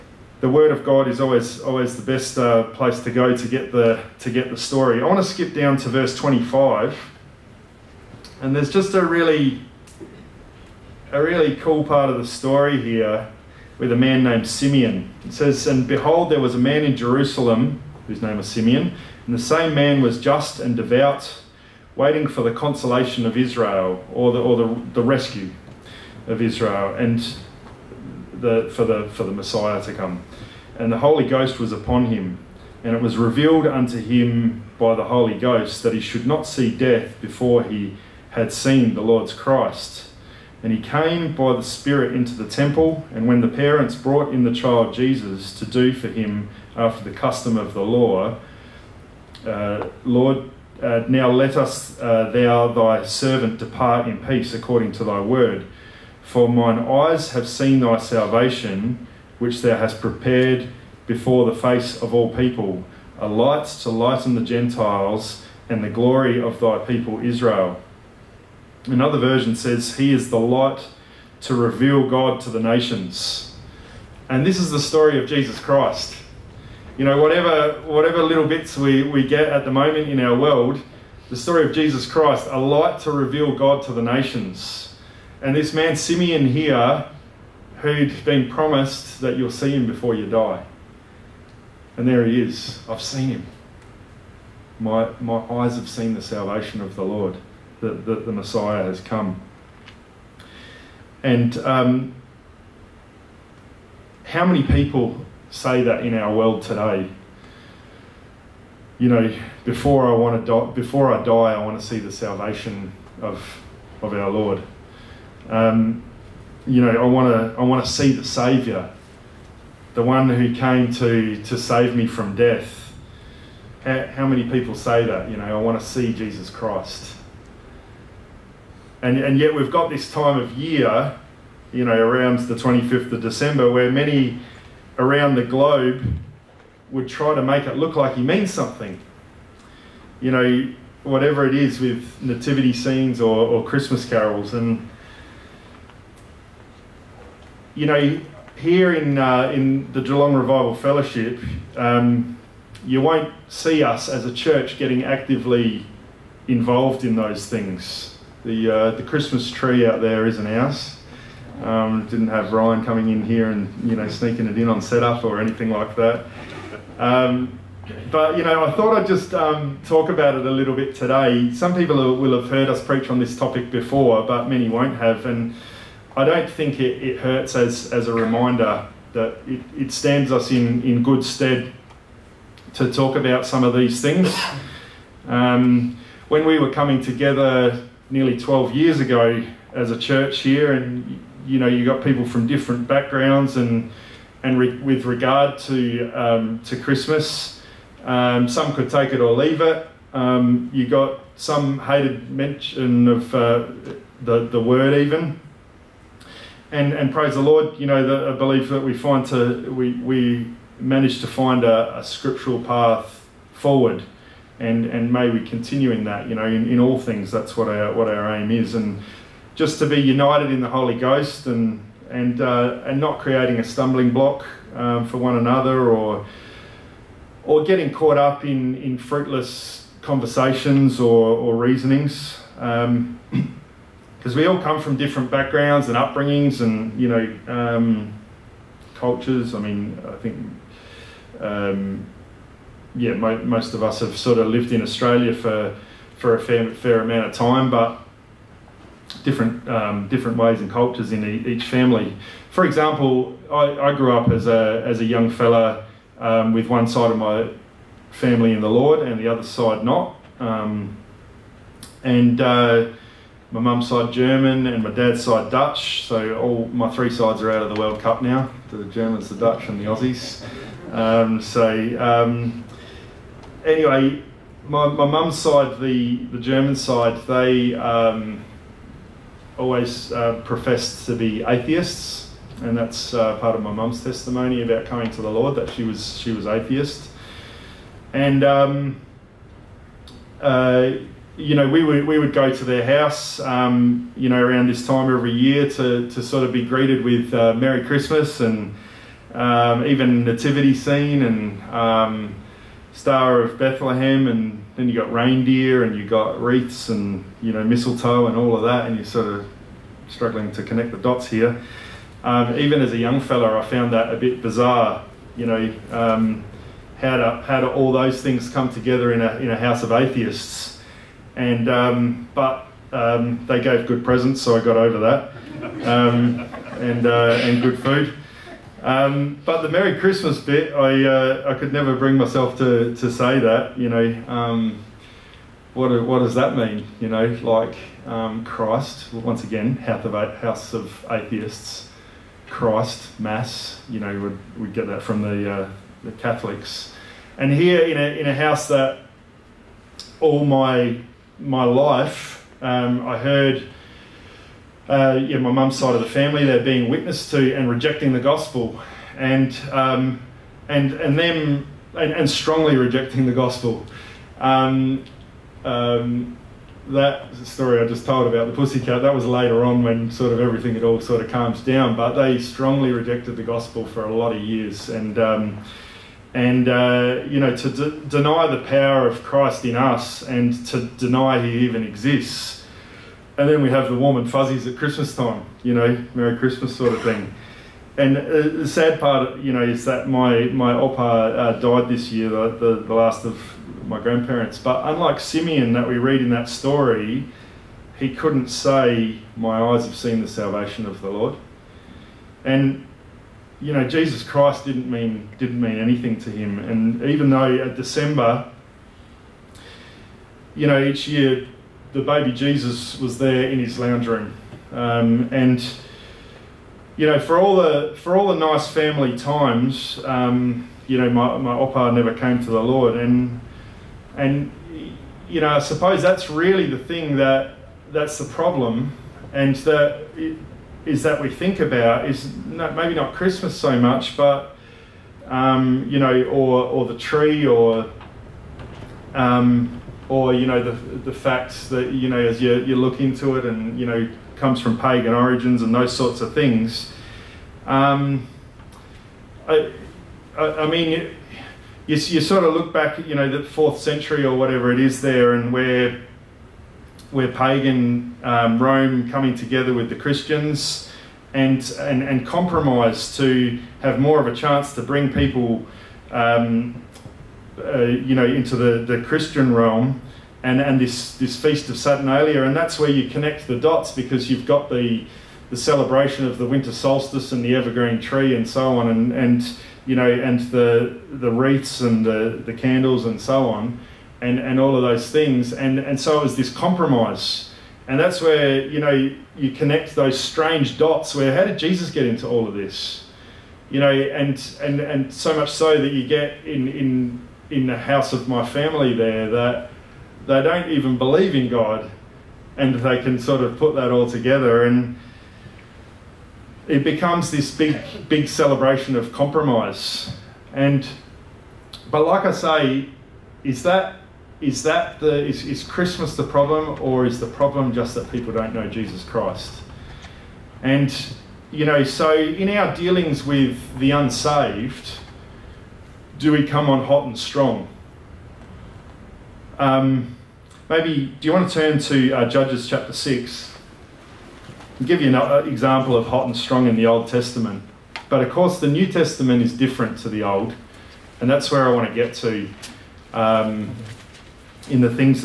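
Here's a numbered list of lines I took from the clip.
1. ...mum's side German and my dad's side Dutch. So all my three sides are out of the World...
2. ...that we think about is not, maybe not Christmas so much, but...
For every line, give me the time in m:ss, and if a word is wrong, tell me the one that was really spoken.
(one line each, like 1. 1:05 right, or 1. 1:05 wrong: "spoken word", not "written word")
1. 4:23 right
2. 7:11 right.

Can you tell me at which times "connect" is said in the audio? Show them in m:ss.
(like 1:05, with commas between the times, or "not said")
5:10, 7:53, 8:09.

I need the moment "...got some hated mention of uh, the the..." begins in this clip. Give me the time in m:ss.
3:20.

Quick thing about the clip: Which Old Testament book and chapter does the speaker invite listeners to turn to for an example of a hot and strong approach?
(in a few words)
Judges 6.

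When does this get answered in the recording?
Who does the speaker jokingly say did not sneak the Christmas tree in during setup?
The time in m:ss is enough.
2:42.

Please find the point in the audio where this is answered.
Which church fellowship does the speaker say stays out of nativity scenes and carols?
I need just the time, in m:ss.
2:30.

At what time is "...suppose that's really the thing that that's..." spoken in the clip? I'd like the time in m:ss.
7:05.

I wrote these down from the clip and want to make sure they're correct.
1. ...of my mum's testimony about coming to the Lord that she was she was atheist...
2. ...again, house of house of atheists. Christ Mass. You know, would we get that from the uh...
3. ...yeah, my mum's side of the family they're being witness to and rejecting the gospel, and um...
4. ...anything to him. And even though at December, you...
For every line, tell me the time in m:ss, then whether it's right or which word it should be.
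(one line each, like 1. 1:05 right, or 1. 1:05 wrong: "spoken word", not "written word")
1. 4:43 right
2. 5:39 right
3. 5:55 right
4. 6:45 right.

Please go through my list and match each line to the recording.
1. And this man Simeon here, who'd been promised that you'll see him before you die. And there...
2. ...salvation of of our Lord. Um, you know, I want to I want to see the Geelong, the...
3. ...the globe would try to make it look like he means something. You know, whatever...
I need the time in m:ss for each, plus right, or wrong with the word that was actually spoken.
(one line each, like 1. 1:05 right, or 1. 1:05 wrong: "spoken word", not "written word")
1. 1:25 right
2. 1:52 wrong: "Saviour", not "Geelong"
3. 2:15 right.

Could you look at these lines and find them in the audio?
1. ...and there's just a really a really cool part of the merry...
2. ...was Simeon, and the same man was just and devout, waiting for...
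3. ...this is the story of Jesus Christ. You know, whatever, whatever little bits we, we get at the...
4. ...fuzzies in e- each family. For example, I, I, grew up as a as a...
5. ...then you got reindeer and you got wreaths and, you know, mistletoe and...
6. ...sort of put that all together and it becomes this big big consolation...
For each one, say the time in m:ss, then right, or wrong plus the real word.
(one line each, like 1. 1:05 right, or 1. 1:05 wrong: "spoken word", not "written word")
1. 0:08 wrong: "story", not "merry"
2. 0:18 right
3. 1:14 right
4. 4:10 wrong: "cultures", not "fuzzies"
5. 5:04 right
6. 8:23 wrong: "celebration", not "consolation".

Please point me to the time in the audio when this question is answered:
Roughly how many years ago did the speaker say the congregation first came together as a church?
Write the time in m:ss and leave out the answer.
3:08.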